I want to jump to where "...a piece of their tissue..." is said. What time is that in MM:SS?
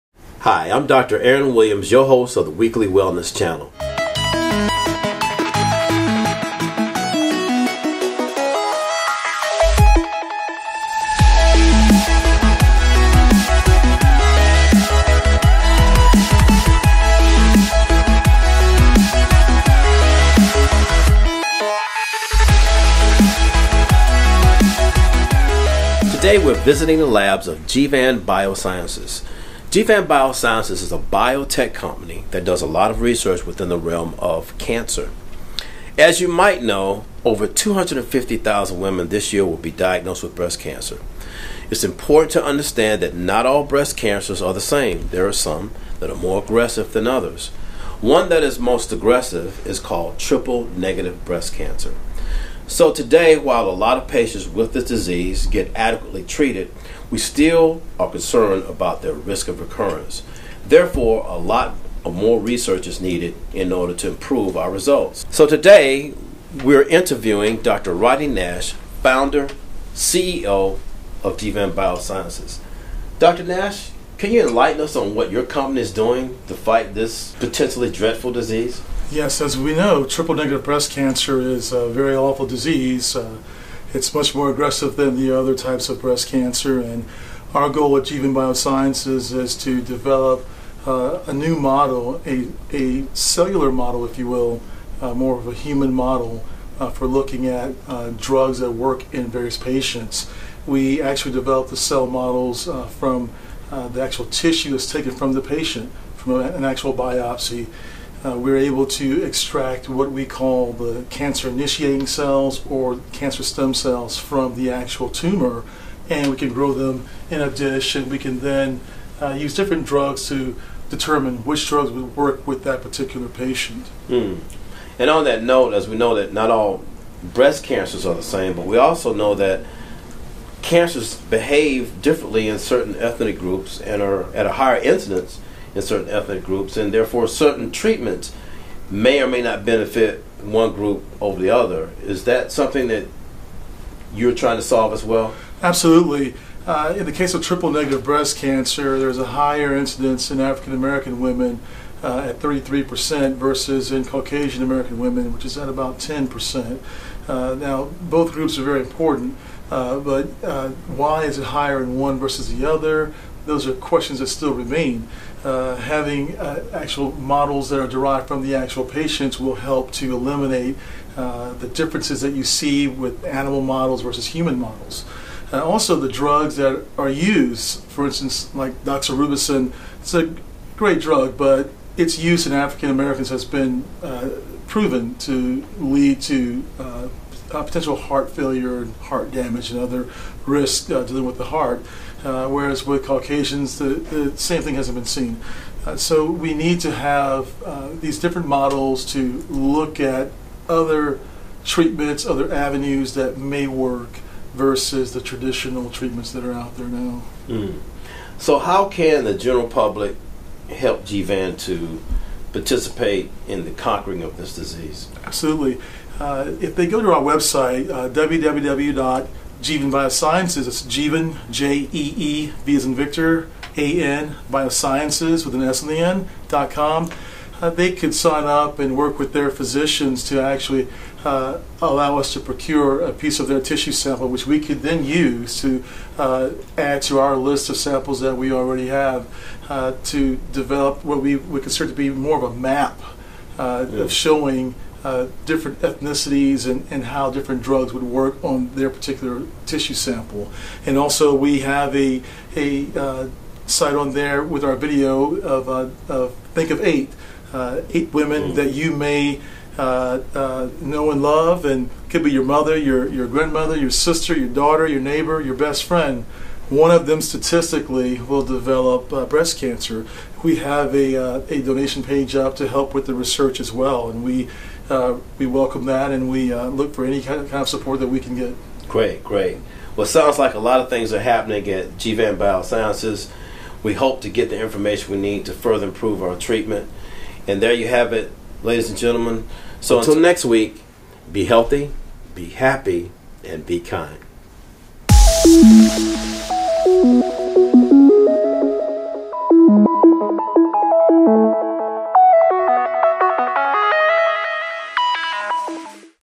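03:53.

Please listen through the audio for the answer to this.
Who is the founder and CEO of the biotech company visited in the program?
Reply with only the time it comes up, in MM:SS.
01:07.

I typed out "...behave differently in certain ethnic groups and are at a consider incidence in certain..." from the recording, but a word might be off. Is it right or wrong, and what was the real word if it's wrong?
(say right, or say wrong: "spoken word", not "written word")
wrong: "higher", not "consider".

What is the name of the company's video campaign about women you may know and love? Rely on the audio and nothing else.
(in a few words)
Think of Eight.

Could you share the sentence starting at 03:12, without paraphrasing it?
Uh, whereas with Caucasians, the, the same thing hasn't been seen.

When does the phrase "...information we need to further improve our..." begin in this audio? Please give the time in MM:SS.
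04:44.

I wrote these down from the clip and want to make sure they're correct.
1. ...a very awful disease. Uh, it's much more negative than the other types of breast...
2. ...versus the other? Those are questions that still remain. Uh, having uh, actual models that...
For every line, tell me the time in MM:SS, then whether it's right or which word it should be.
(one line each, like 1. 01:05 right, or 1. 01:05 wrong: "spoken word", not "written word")
1. 01:21 wrong: "aggressive", not "negative"
2. 02:42 right.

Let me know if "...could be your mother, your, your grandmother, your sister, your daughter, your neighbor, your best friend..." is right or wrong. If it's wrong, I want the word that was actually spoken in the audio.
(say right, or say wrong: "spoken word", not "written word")
right.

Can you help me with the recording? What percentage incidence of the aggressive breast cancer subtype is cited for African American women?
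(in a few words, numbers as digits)
33%.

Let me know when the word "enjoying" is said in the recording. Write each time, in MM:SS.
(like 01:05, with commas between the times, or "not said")
not said.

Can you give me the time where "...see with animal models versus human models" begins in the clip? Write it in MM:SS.
02:52.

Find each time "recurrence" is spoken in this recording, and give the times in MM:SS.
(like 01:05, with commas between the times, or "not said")
00:59.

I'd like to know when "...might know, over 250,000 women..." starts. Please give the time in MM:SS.
00:36.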